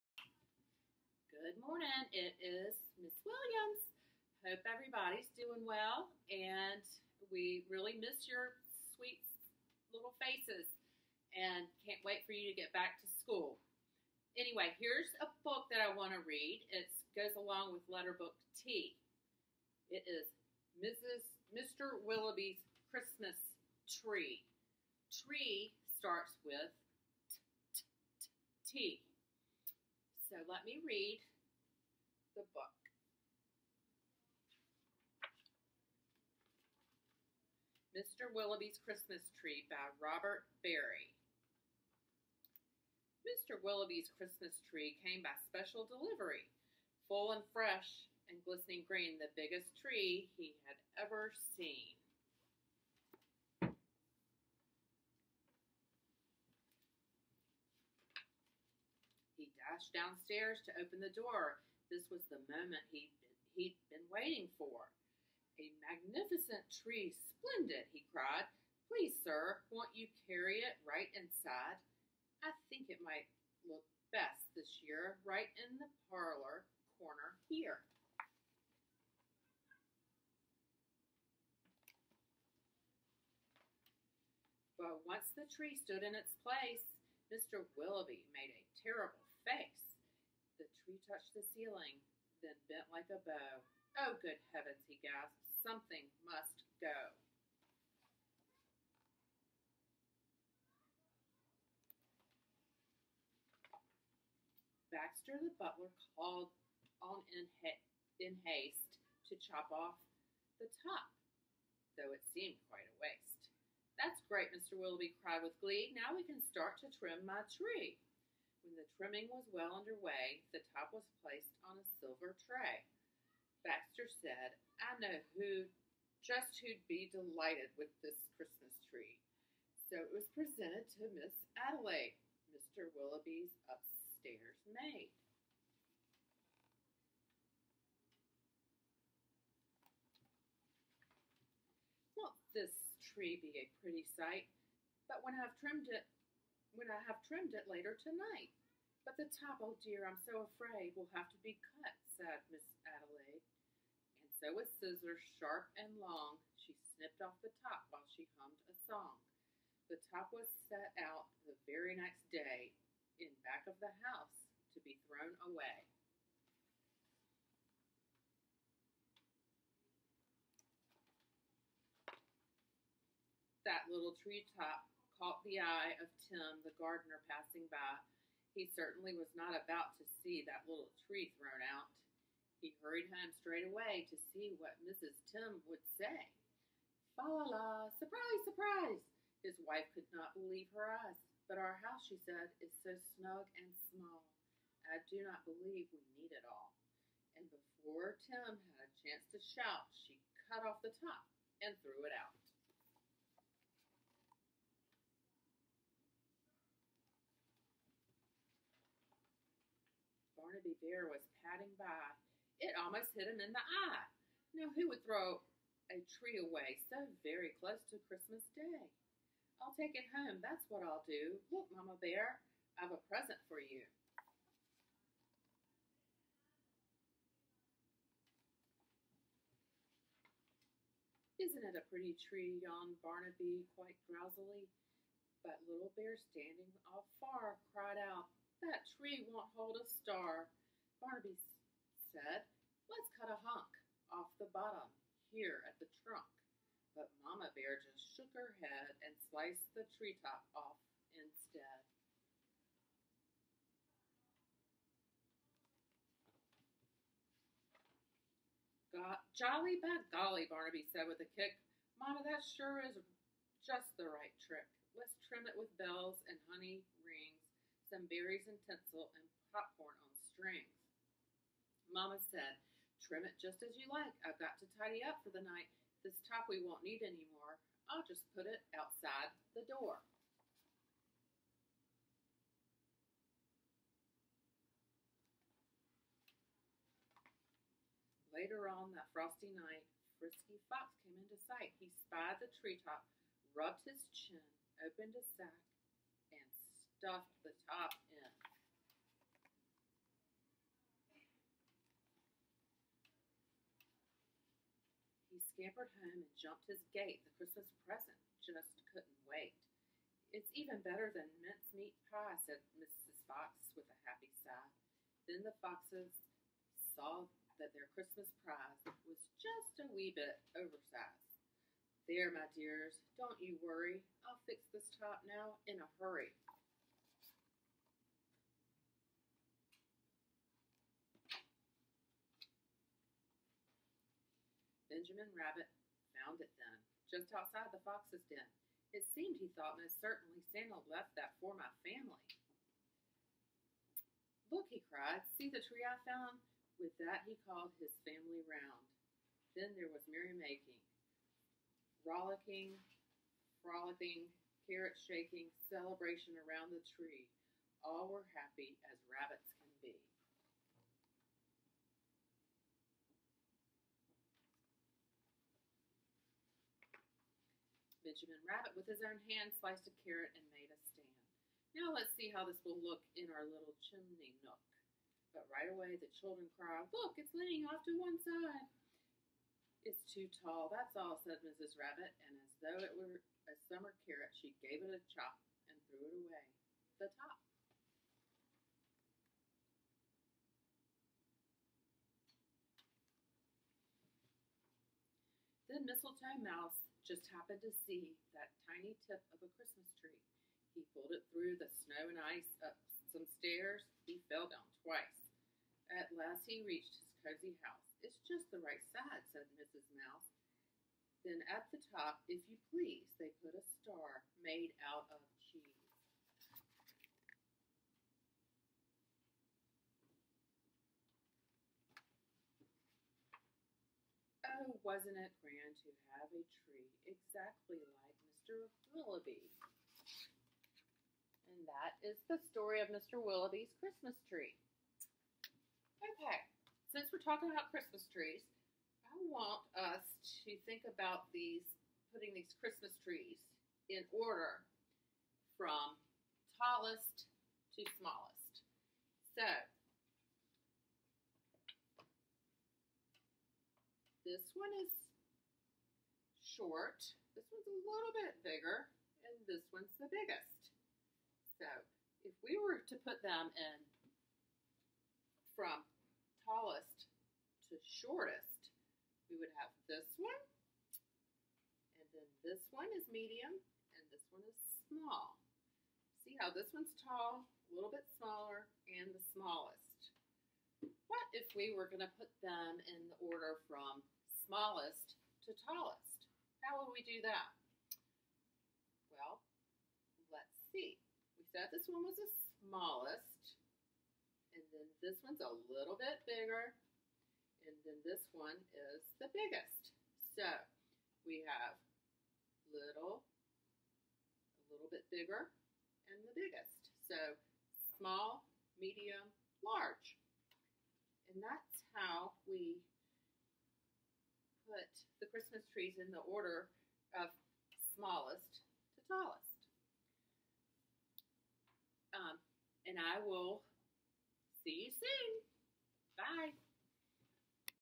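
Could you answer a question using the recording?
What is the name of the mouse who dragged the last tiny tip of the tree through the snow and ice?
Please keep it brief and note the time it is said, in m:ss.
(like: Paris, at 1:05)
Mistletoe Mouse, at 6:35.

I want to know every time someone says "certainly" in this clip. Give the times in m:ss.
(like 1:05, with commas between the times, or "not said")
2:58, 5:40.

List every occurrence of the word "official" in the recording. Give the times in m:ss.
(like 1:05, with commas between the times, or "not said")
not said.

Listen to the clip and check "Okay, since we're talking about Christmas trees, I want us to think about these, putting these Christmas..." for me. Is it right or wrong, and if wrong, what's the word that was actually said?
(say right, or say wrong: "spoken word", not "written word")
right.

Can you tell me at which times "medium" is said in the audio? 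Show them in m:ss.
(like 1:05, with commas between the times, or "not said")
7:53, 8:28.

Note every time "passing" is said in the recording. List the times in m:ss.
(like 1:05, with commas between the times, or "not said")
2:57.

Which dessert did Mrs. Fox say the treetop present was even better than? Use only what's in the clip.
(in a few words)
Mincemeat pie.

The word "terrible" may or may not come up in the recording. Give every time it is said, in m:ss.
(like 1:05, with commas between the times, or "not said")
1:28.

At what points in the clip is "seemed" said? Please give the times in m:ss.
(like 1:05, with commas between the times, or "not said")
1:52, 5:39.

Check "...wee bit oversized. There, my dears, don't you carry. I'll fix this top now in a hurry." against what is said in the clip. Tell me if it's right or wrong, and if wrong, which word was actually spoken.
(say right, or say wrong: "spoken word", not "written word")
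wrong: "worry", not "carry".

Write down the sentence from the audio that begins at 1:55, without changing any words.
Now we can start to trim my tree.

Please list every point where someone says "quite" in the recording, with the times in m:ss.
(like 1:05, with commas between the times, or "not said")
1:52, 3:53.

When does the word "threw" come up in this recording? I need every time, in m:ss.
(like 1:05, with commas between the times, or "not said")
3:21, 6:25.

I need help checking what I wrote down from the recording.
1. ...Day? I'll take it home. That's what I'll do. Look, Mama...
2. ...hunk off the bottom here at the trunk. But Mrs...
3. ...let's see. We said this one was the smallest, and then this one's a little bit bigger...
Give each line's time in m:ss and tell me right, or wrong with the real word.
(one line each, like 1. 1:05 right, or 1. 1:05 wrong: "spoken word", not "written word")
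1. 3:38 right
2. 4:03 wrong: "Mama", not "Mrs"
3. 8:10 right.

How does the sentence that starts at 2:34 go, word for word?
And so with scissors sharp and long, she snipped off the top while she hummed a song.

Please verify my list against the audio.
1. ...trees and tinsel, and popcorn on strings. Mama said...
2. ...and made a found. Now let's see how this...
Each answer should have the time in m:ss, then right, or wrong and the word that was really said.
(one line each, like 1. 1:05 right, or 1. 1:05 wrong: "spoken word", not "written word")
1. 4:28 wrong: "berries", not "trees"
2. 6:10 wrong: "stand", not "found".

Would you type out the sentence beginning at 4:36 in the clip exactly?
This top we won't need anymore.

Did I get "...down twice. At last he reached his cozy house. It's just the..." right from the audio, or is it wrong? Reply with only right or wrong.
right.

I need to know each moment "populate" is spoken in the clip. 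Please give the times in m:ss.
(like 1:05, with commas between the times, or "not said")
not said.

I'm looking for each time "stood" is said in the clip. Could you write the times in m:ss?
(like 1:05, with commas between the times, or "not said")
1:25.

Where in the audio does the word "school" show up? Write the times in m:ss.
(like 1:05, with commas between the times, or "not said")
0:13.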